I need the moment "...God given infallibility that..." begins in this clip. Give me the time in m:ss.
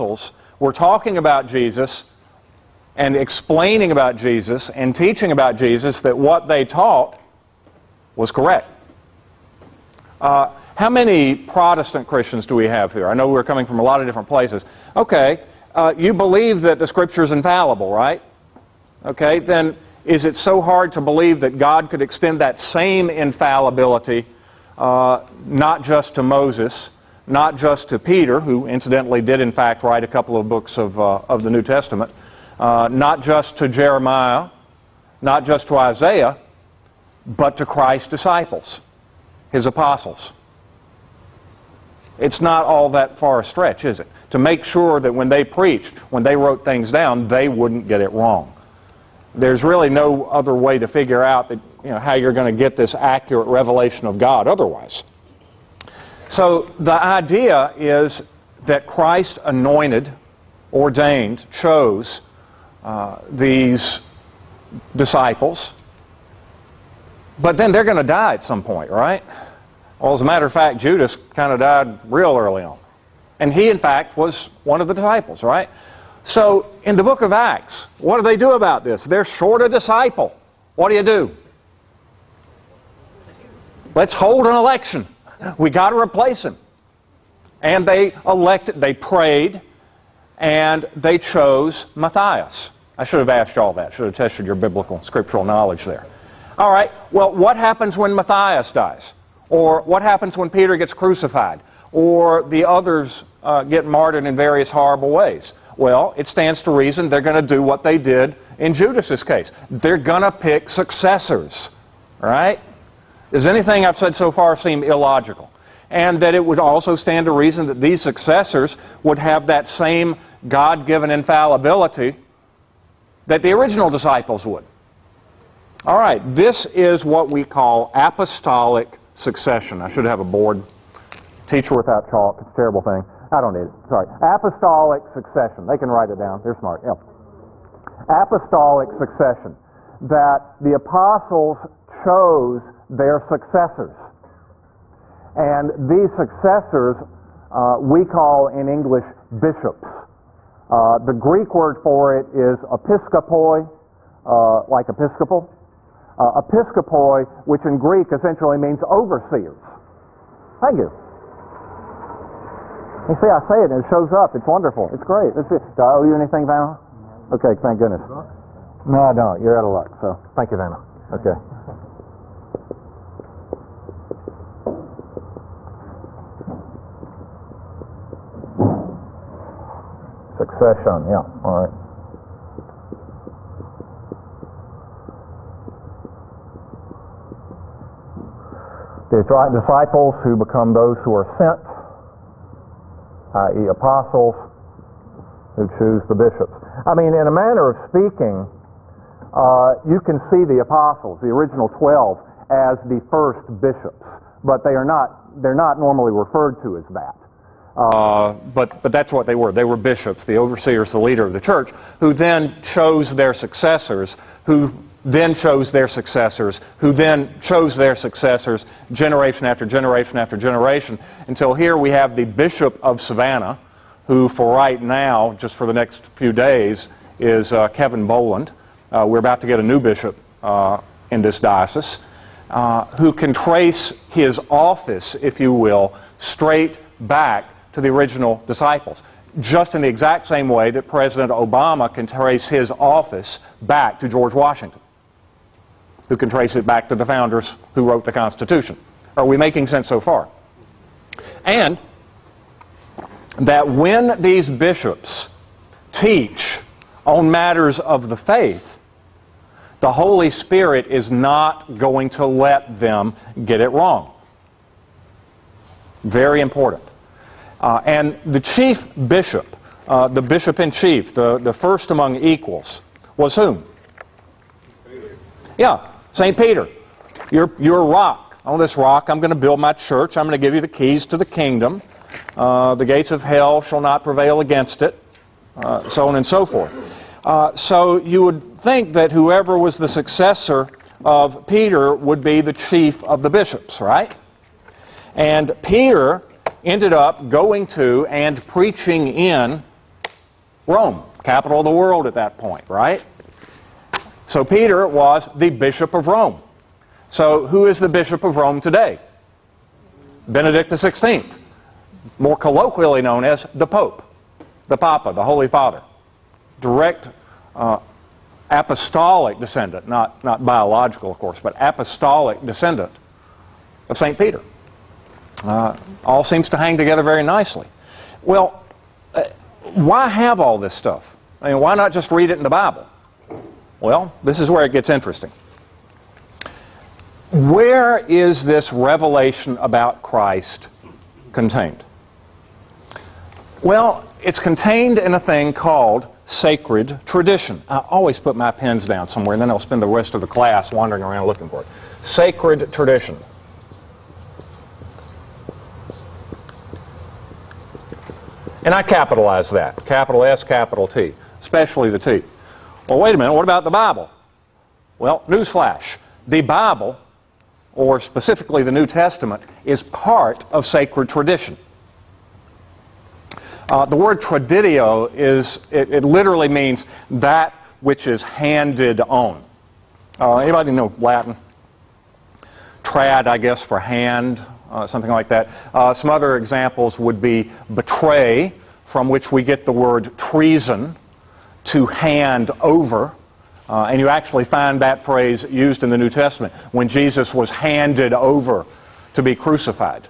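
2:00.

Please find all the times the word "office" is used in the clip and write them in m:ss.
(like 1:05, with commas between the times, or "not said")
3:54, 4:02.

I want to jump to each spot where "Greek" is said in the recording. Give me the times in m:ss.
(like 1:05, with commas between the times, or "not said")
2:31, 2:37.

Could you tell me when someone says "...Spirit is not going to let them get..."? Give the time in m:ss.
4:20.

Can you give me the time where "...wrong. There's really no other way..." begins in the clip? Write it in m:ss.
0:48.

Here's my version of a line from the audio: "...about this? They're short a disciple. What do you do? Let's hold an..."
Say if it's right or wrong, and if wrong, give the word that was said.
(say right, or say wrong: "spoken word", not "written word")
right.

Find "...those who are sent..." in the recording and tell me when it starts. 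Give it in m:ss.
3:10.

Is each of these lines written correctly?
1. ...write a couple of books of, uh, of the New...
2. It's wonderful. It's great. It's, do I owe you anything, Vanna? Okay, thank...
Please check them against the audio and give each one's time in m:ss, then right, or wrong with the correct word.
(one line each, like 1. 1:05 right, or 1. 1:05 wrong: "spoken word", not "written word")
1. 0:29 right
2. 2:44 right.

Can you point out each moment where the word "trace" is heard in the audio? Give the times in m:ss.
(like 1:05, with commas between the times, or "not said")
3:53, 4:02, 4:06.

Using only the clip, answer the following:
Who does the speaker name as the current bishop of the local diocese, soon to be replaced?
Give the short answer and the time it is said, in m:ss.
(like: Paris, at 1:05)
Kevin Boland, at 3:47.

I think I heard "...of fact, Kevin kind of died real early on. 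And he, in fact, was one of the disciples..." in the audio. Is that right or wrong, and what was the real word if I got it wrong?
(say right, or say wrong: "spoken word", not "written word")
wrong: "Judas", not "Kevin".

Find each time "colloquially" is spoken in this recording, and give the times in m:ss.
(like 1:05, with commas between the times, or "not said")
5:12.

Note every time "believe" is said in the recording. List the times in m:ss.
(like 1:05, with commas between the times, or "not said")
0:16, 0:20.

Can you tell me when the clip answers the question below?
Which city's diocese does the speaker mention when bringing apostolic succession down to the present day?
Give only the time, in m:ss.
3:42.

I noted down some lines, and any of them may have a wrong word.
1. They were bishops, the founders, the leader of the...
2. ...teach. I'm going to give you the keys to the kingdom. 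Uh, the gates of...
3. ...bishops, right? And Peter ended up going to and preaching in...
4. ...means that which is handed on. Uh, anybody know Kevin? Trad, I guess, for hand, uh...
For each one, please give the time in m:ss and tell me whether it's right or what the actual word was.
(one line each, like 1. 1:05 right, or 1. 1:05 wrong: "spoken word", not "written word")
1. 3:29 wrong: "overseers", not "founders"
2. 4:39 wrong: "church", not "teach"
3. 4:53 right
4. 6:16 wrong: "Latin", not "Kevin".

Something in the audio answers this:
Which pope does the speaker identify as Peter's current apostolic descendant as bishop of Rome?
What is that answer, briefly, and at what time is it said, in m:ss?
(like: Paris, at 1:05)
Benedict XVI, at 5:10.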